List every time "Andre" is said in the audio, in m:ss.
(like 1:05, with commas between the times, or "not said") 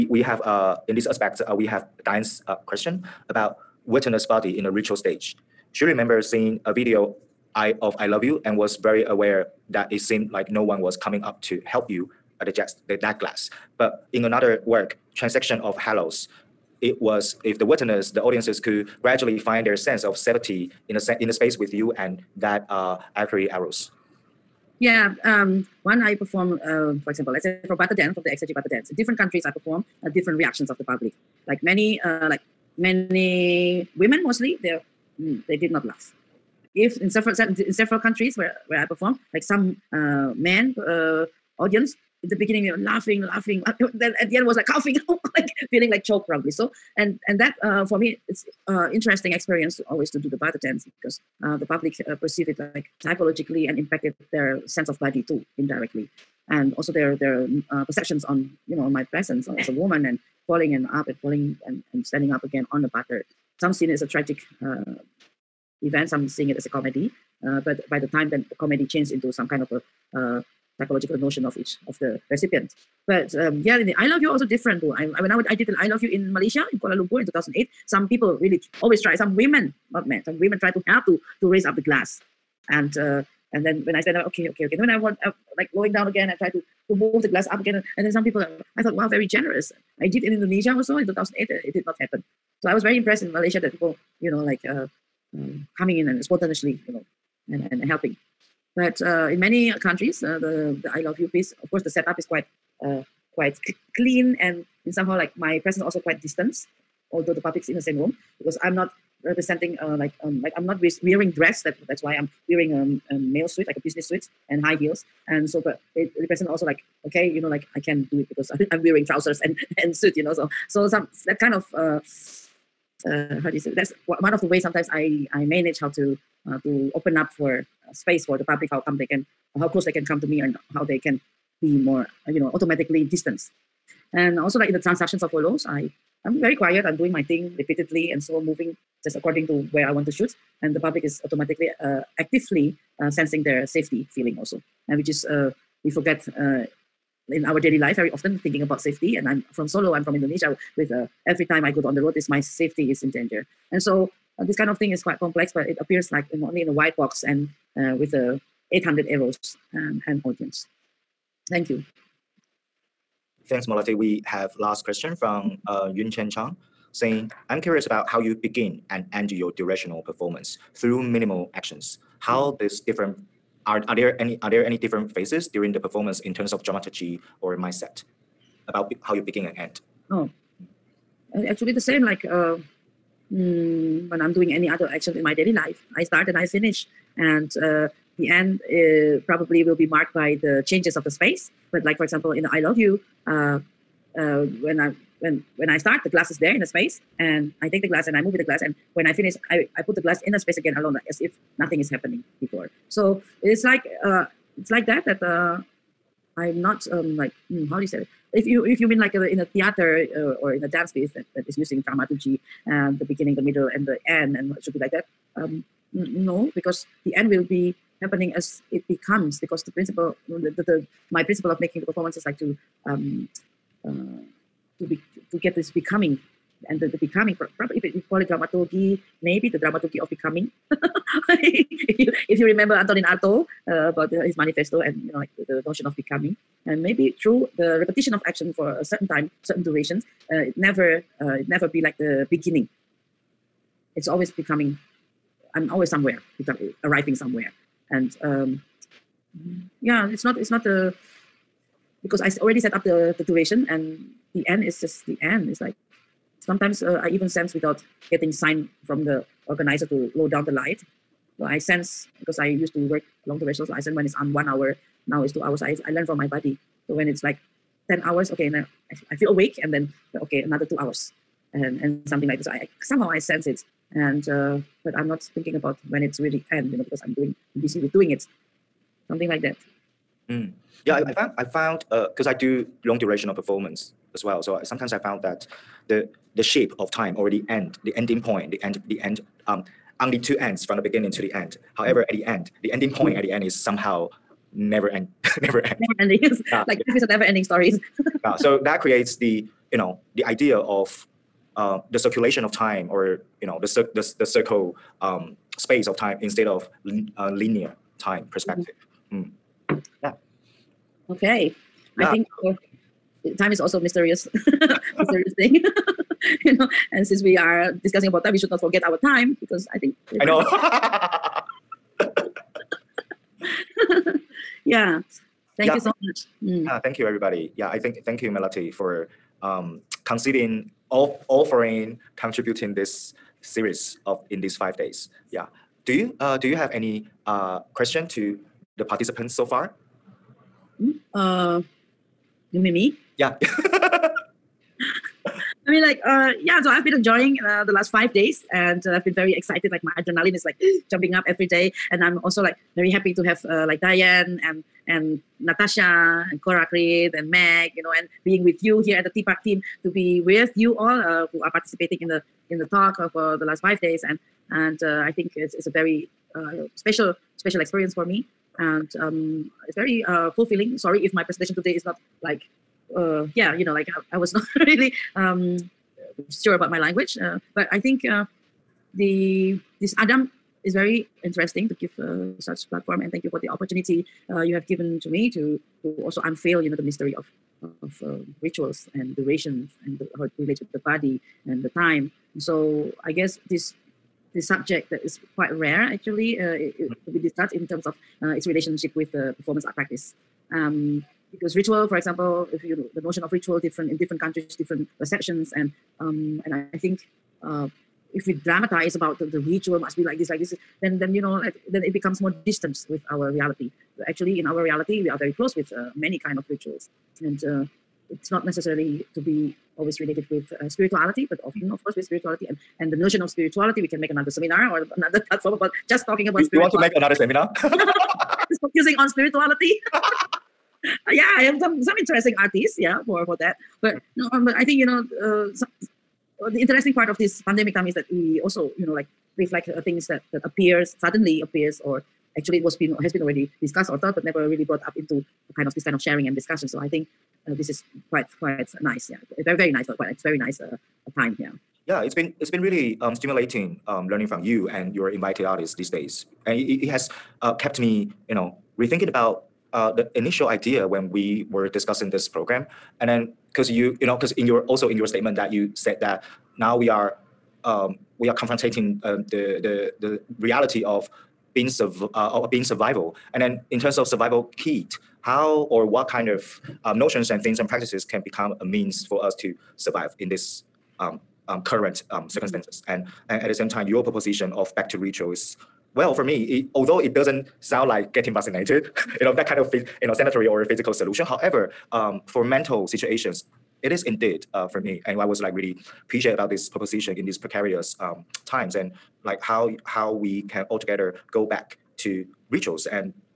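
not said.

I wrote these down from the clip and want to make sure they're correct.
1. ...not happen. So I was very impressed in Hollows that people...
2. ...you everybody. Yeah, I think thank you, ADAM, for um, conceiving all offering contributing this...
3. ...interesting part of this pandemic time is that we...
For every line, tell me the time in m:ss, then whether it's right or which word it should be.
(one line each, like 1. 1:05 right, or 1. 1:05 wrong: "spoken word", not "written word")
1. 1:31 wrong: "Malaysia", not "Hollows"
2. 5:26 wrong: "Melati", not "ADAM"
3. 7:16 right.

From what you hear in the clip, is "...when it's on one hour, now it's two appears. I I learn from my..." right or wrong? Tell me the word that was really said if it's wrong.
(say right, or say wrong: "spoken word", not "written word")
wrong: "hours", not "appears".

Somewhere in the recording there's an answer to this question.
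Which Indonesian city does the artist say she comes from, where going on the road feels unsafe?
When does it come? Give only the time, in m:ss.
2:29.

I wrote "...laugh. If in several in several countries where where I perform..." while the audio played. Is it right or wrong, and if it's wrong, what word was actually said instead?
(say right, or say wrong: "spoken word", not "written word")
right.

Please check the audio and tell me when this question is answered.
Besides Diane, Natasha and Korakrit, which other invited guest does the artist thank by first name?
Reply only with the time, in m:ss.
5:57.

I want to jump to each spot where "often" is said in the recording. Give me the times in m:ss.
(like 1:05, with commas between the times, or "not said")
2:28, 7:01.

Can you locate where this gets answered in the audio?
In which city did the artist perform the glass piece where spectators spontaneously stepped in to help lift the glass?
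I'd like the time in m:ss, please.
1:16.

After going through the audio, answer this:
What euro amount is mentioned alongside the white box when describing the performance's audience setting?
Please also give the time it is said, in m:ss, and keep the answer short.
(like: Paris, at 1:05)
800 euros, at 2:38.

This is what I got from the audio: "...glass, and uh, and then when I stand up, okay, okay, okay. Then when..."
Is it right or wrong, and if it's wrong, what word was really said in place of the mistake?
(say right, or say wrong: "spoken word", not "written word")
right.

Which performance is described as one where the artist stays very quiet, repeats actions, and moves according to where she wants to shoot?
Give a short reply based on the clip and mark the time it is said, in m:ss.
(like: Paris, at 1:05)
Transactions of Hollows, at 2:14.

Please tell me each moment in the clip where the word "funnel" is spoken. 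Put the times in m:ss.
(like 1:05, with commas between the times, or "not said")
not said.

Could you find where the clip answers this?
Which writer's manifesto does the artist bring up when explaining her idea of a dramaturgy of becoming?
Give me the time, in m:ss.
3:52.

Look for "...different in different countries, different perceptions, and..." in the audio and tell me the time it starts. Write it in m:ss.
6:43.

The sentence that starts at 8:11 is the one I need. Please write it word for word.
However, um, for mental situations, it is indeed uh, for me.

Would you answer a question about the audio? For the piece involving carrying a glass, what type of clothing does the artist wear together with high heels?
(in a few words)
A business suit.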